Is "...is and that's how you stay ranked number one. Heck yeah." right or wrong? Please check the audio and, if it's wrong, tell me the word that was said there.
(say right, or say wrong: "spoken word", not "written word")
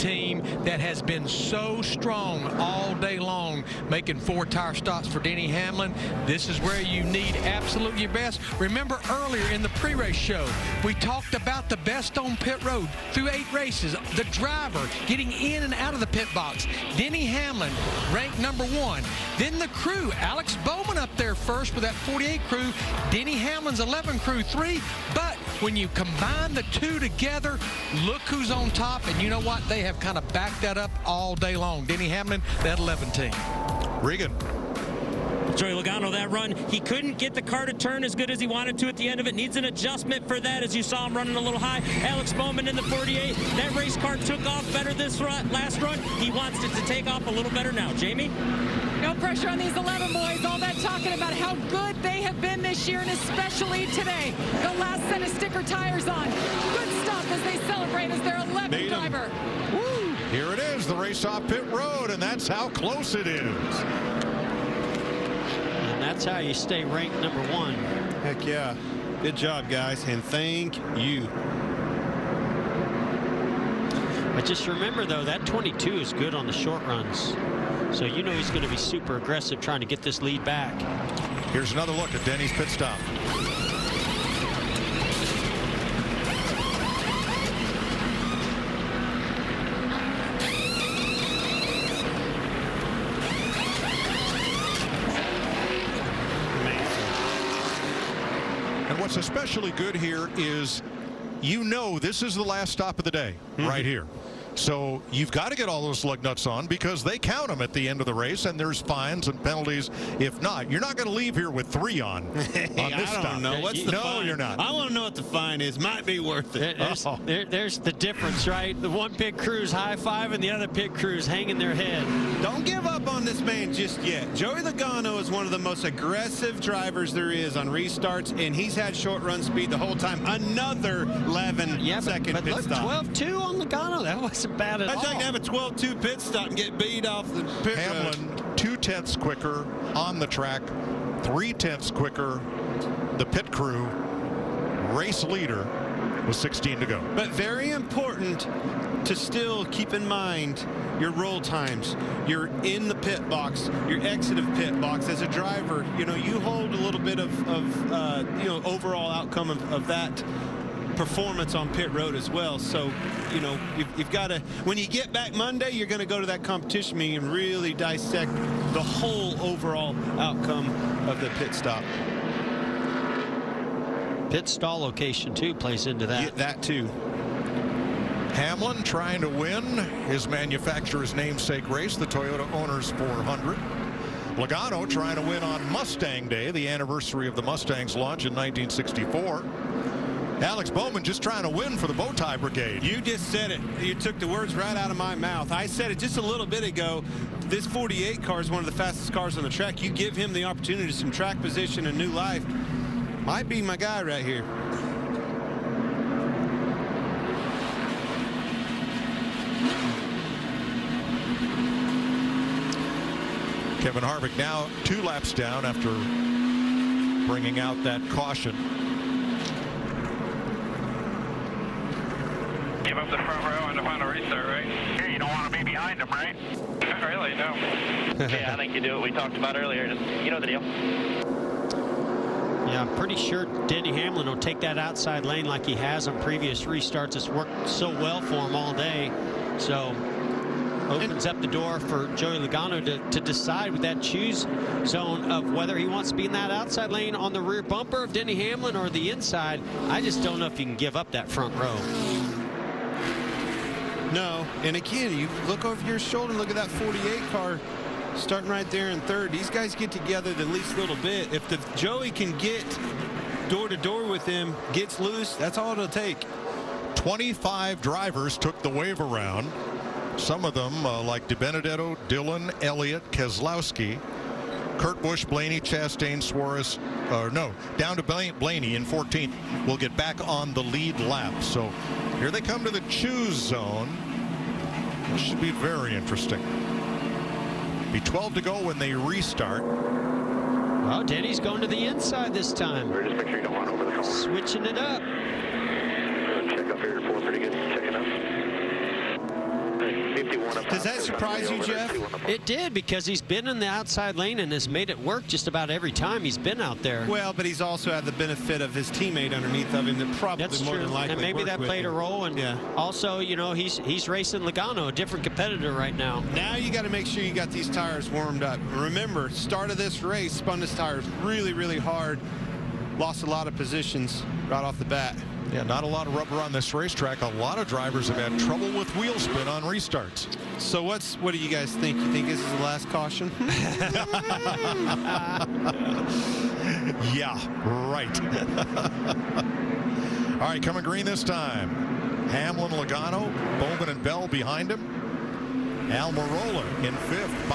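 right.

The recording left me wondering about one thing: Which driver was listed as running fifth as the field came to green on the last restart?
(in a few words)
Almirola.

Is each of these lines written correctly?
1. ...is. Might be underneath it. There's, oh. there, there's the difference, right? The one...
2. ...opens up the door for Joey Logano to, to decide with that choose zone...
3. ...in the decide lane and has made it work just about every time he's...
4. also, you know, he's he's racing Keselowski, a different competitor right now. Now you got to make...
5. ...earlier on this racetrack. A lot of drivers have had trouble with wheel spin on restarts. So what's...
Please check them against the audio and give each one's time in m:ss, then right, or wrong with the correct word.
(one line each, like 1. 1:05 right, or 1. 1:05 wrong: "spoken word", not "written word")
1. 1:55 wrong: "worth", not "underneath"
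2. 4:00 right
3. 5:03 wrong: "outside", not "decide"
4. 5:12 wrong: "Logano", not "Keselowski"
5. 5:26 wrong: "rubber", not "earlier".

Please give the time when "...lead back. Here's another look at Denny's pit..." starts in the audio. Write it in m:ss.
1:20.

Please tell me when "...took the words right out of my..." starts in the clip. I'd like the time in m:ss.
3:13.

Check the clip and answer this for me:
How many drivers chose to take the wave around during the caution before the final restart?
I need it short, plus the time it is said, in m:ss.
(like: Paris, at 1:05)
25, at 4:26.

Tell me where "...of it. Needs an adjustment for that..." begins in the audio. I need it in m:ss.
0:39.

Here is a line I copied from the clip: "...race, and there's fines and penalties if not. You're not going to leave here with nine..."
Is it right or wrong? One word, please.
wrong.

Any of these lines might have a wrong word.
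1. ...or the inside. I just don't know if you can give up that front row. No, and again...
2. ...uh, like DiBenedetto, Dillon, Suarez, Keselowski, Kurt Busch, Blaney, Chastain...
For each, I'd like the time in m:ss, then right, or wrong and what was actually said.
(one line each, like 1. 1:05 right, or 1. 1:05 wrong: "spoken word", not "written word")
1. 4:08 right
2. 4:30 wrong: "Elliott", not "Suarez".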